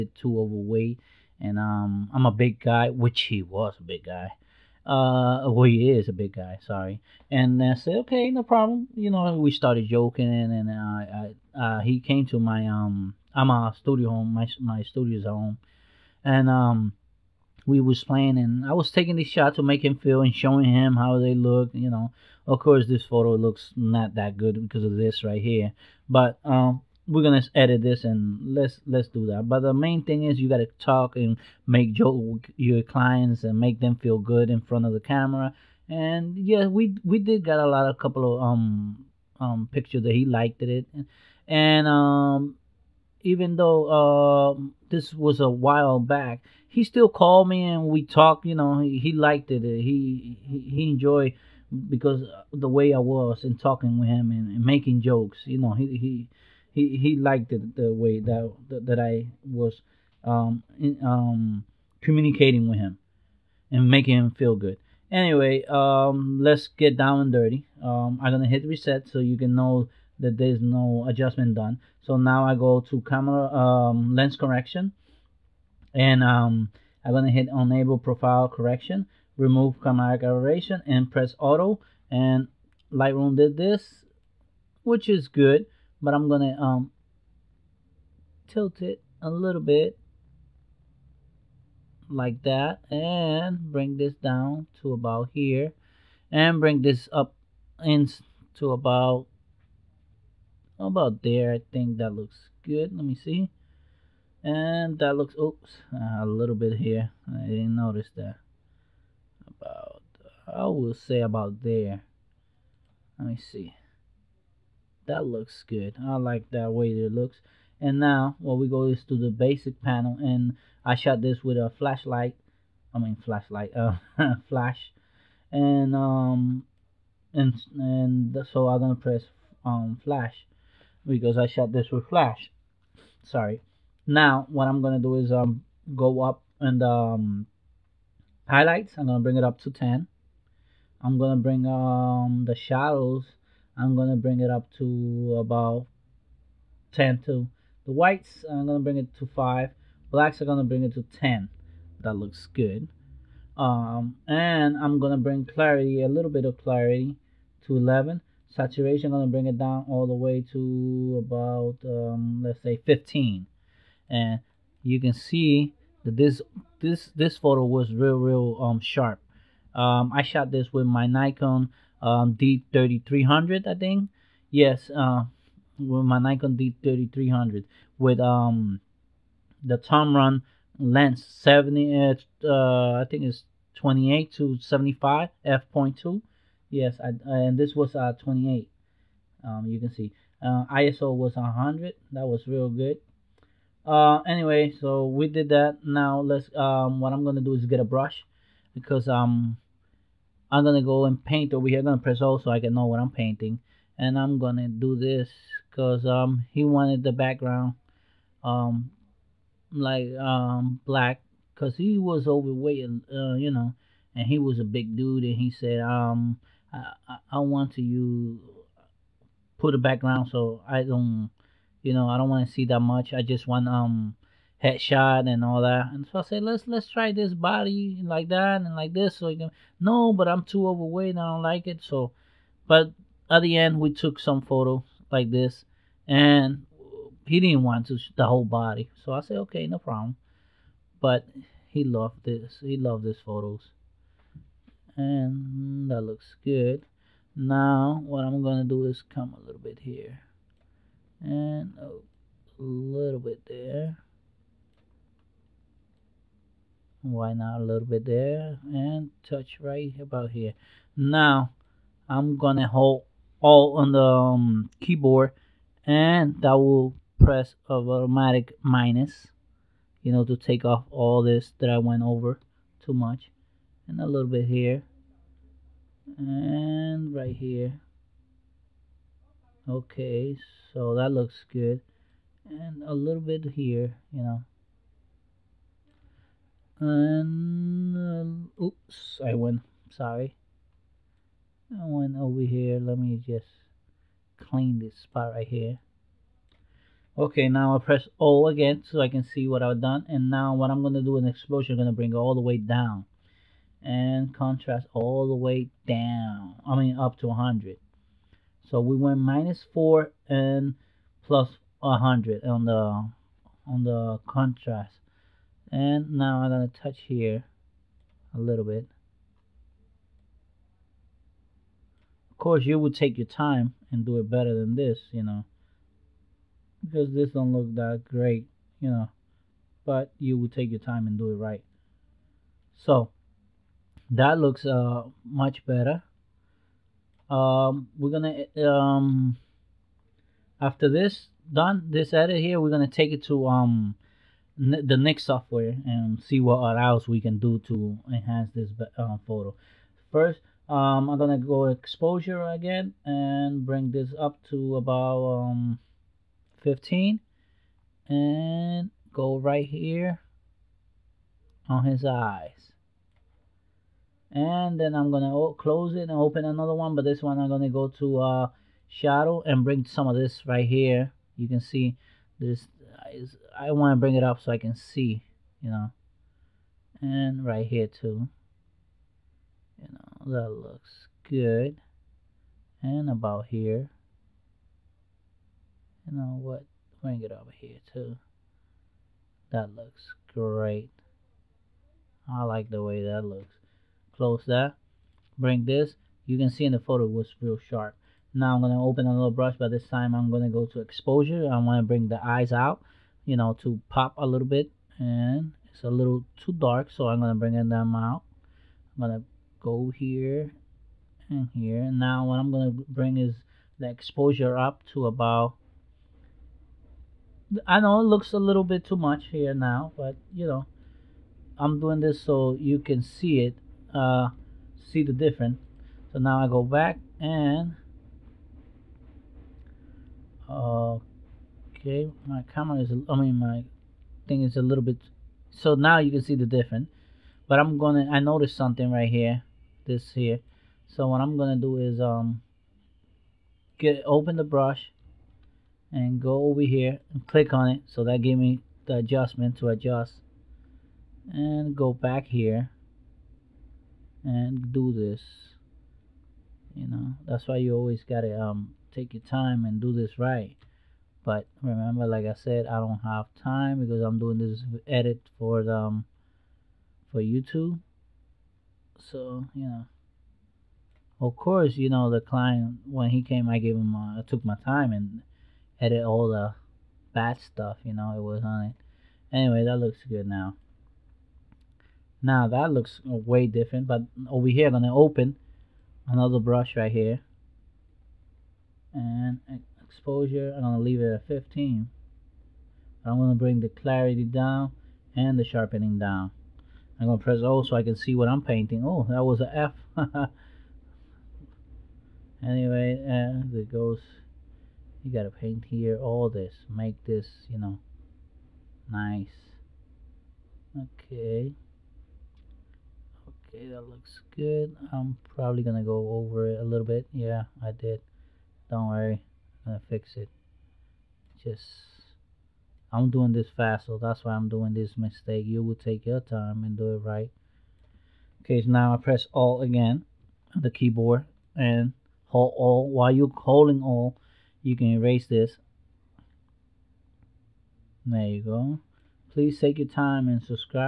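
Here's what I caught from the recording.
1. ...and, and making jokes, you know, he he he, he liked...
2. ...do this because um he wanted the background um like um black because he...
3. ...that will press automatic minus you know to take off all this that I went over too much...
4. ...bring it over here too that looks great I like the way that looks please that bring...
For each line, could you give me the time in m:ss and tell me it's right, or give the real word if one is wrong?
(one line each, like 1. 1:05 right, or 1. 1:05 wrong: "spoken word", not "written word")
1. 0:54 right
2. 3:24 right
3. 4:26 right
4. 6:27 wrong: "close", not "please".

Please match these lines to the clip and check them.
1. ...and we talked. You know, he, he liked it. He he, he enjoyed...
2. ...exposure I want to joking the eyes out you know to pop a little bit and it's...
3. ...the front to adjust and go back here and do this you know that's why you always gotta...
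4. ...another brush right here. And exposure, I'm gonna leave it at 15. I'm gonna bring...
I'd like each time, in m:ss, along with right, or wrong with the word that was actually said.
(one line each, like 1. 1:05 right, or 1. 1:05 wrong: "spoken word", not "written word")
1. 0:47 right
2. 6:40 wrong: "bring", not "joking"
3. 7:28 wrong: "adjustment", not "front"
4. 8:06 right.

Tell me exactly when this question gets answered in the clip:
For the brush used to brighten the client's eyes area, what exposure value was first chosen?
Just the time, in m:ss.
5:54.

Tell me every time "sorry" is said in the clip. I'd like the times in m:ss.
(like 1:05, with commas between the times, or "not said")
0:06, 2:13, 4:49.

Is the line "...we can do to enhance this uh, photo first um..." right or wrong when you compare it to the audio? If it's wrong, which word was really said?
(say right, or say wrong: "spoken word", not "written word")
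right.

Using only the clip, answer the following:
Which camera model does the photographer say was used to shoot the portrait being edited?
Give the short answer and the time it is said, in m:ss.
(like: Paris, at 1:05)
Nikon D3300, at 2:56.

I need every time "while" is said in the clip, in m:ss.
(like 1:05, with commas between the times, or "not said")
0:45, 8:52.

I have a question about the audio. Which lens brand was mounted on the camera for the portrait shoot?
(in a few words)
Tamron.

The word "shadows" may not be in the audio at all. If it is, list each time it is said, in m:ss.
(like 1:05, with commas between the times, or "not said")
2:22, 6:08.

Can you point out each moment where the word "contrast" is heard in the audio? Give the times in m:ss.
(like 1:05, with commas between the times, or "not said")
5:04, 5:14.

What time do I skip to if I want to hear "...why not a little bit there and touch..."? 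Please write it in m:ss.
4:17.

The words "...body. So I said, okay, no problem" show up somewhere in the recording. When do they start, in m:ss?
3:58.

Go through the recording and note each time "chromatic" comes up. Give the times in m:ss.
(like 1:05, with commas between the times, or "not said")
1:19.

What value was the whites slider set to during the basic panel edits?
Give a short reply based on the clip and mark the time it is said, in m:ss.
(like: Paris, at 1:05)
5, at 2:27.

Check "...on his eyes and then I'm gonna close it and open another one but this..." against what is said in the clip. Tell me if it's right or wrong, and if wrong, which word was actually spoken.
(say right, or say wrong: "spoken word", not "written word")
right.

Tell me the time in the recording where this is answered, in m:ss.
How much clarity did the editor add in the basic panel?
2:35.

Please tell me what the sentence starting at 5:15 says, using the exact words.
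And now I'm gonna touch here a little bit.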